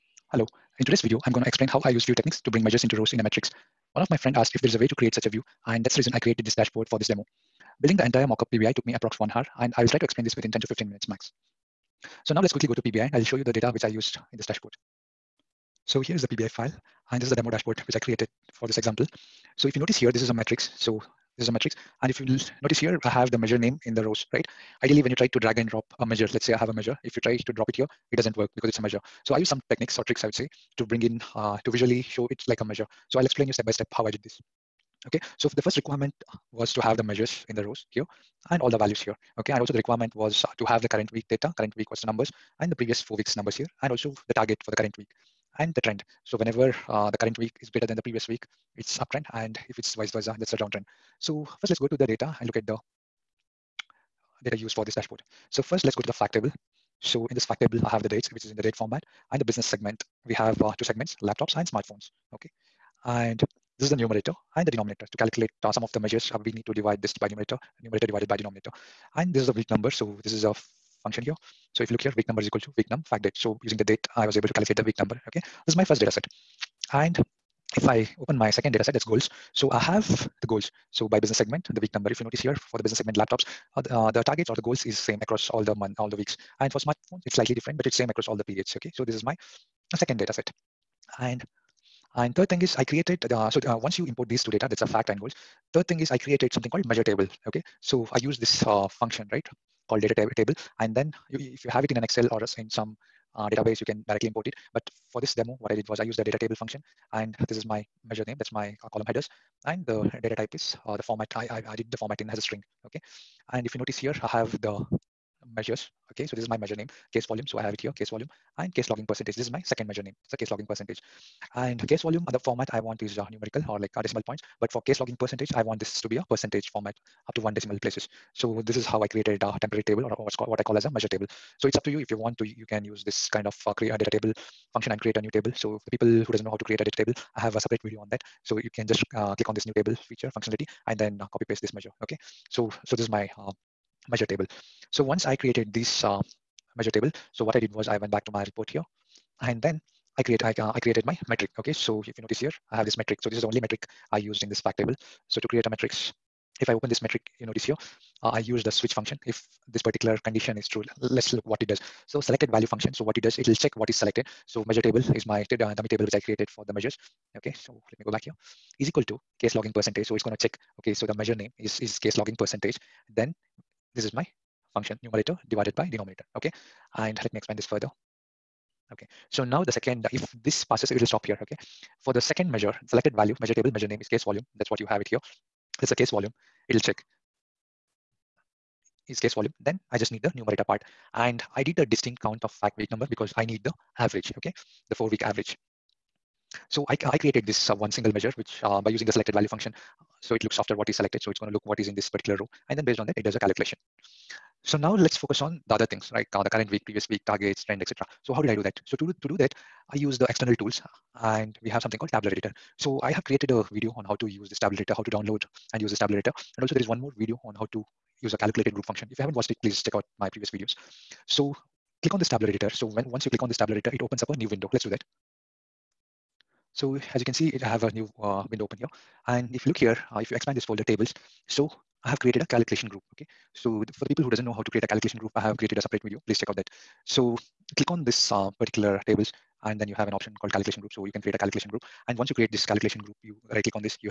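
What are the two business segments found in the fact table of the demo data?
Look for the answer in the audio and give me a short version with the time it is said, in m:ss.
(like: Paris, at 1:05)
laptops and smartphones, at 1:01.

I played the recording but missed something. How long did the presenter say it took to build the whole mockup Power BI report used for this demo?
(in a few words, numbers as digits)
approx one hour.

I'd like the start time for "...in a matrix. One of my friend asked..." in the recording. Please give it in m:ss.
0:03.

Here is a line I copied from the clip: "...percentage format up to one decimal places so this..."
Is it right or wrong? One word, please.
right.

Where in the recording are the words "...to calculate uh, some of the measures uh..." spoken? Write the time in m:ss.
1:05.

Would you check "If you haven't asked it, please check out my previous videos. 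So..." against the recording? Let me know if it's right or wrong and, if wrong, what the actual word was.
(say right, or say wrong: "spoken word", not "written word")
wrong: "watched", not "asked".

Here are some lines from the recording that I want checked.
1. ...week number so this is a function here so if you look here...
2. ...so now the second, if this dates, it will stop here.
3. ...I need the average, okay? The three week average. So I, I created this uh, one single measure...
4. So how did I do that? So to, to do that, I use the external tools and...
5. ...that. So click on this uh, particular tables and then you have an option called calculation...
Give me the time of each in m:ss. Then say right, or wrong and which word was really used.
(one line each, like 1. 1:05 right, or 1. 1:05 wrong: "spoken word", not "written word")
1. 1:09 right
2. 2:59 wrong: "passes", not "dates"
3. 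3:13 wrong: "four", not "three"
4. 3:28 right
5. 3:56 right.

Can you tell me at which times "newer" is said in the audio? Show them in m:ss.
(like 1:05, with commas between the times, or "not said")
not said.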